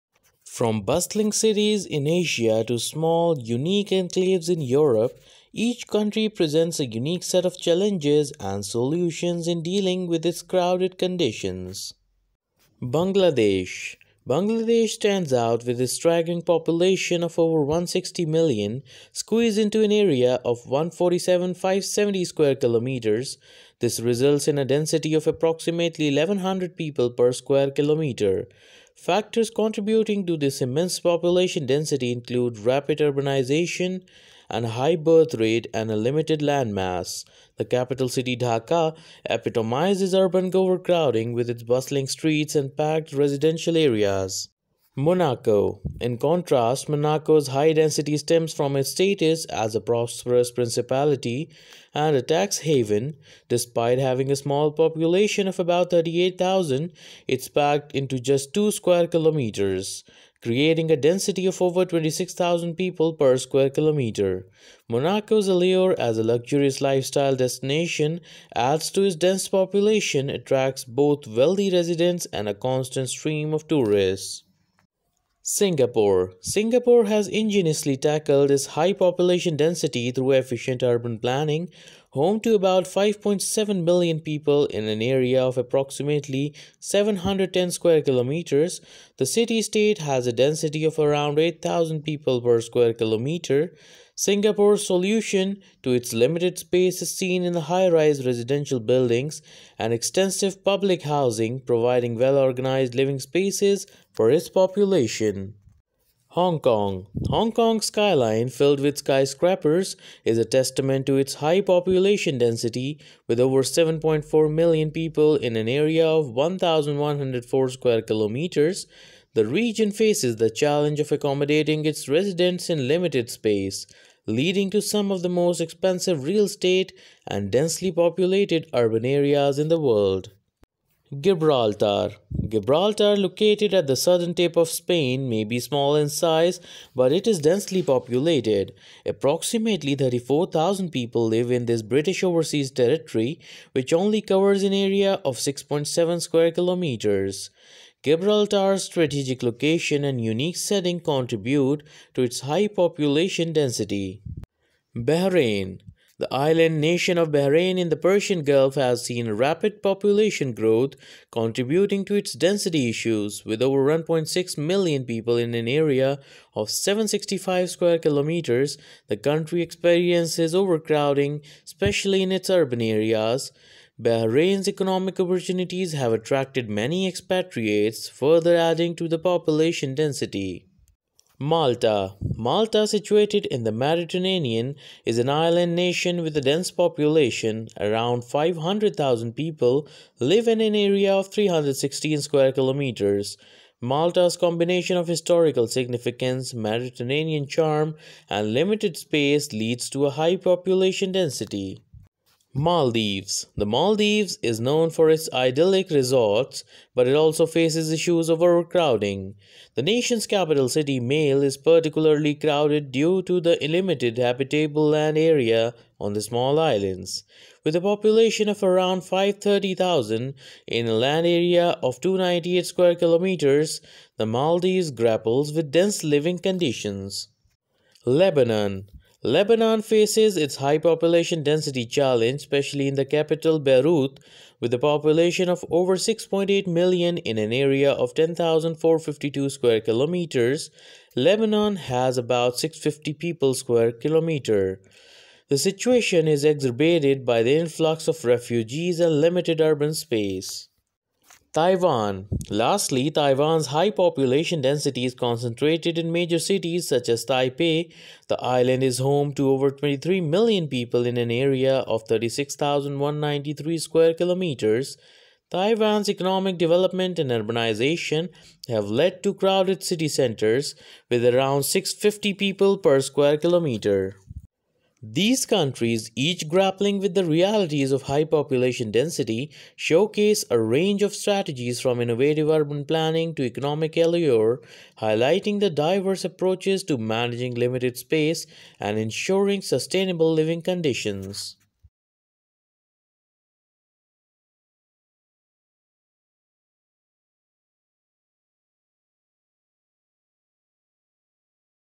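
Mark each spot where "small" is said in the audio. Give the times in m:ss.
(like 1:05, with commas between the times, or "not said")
0:02, 0:54, 2:15, 3:36.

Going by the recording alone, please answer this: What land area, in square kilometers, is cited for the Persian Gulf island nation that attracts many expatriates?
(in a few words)
765.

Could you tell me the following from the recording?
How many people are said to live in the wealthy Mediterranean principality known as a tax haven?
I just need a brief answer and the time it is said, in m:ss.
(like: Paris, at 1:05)
about 38,000, at 0:55.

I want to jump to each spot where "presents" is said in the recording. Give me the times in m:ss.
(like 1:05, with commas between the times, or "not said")
0:06.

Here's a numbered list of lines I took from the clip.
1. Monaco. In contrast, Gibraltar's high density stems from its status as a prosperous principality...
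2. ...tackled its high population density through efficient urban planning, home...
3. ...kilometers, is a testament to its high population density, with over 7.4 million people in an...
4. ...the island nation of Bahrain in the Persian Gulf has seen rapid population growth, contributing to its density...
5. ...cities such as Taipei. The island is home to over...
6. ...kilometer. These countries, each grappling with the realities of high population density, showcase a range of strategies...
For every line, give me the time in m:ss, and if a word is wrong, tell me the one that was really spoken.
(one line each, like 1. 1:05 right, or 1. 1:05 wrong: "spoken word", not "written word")
1. 0:44 wrong: "Monaco", not "Gibraltar"
2. 1:17 right
3. 1:48 wrong: "skyscrapers", not "kilometers"
4. 2:36 right
5. 4:16 right
6. 4:33 right.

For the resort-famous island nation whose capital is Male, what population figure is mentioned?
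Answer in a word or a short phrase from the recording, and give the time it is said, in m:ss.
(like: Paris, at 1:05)
around 530,000, at 3:38.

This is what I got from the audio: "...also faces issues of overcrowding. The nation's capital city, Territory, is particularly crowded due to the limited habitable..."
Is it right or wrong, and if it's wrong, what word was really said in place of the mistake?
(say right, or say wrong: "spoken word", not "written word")
wrong: "Male", not "Territory".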